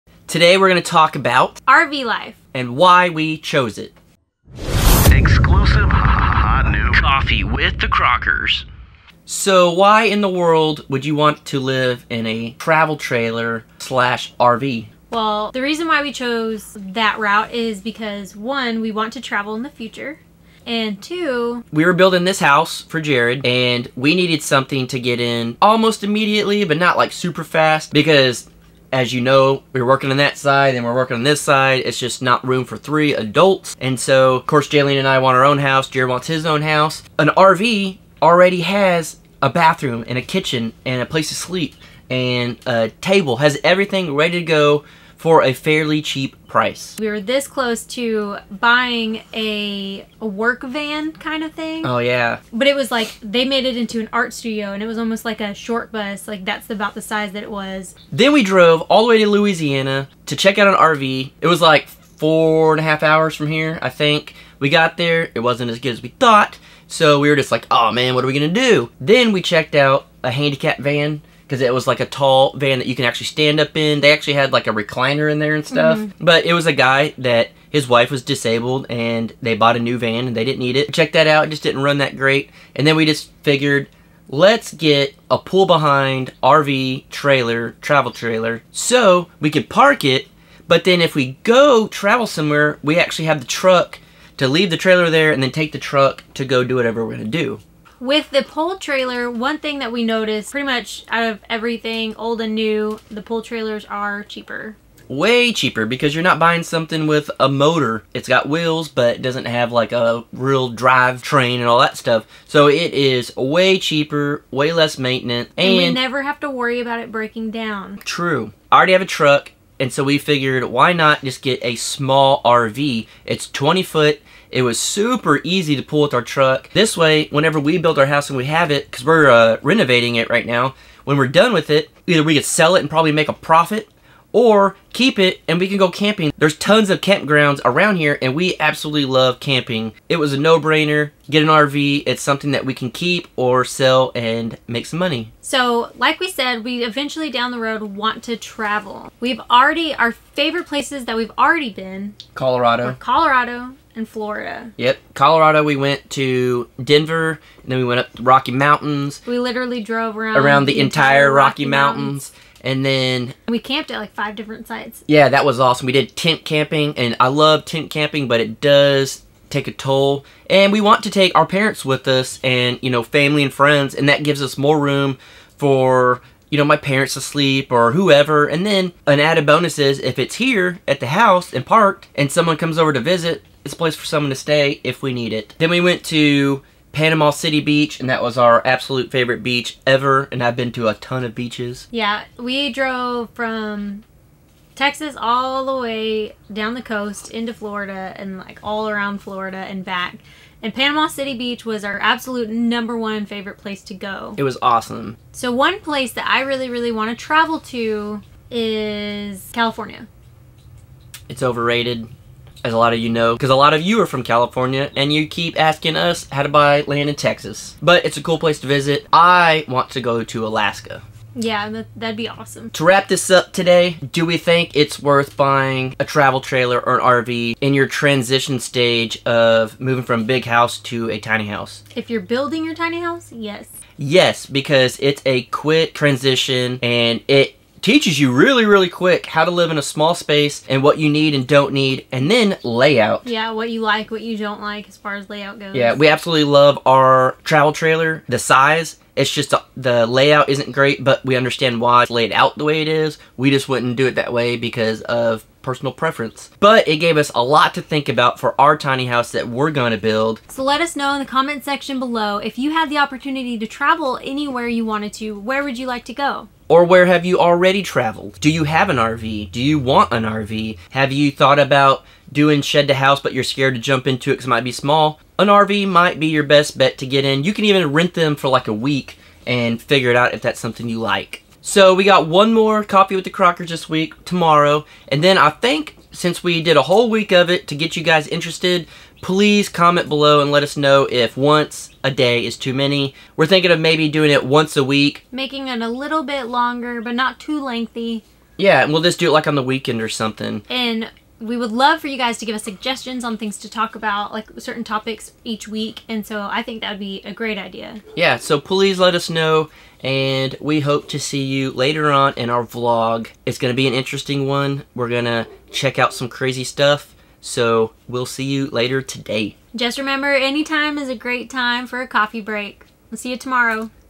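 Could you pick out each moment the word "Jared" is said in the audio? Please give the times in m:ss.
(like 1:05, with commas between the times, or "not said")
0:23, 0:35.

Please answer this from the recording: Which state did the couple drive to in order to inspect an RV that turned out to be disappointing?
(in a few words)
Louisiana.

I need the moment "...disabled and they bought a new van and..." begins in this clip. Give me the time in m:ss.
1:18.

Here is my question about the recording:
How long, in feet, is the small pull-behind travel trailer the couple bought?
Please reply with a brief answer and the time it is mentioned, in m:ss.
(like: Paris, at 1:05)
20 foot, at 2:03.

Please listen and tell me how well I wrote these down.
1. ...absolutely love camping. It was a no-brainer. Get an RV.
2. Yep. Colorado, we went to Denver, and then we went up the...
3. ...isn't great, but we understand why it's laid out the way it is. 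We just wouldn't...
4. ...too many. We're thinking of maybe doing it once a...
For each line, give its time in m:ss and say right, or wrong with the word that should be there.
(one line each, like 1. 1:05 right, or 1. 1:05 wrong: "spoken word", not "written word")
1. 2:18 right
2. 2:34 right
3. 4:10 right
4. 4:52 right.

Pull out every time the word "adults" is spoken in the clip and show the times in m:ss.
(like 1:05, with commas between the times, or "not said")
0:33.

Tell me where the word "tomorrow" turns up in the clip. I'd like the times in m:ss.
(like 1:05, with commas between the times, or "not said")
4:44, 5:23.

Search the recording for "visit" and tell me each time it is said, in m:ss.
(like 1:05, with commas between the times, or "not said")
3:02, 3:38.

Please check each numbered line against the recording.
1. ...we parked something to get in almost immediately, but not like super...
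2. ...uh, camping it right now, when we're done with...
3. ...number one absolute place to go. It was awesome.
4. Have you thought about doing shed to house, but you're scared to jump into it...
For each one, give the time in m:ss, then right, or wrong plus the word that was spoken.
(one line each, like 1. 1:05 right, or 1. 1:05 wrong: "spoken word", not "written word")
1. 0:23 wrong: "needed", not "parked"
2. 2:09 wrong: "renovating", not "camping"
3. 3:22 wrong: "favorite", not "absolute"
4. 4:30 right.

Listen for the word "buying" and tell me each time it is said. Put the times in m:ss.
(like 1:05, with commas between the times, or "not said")
0:48, 1:46, 3:45.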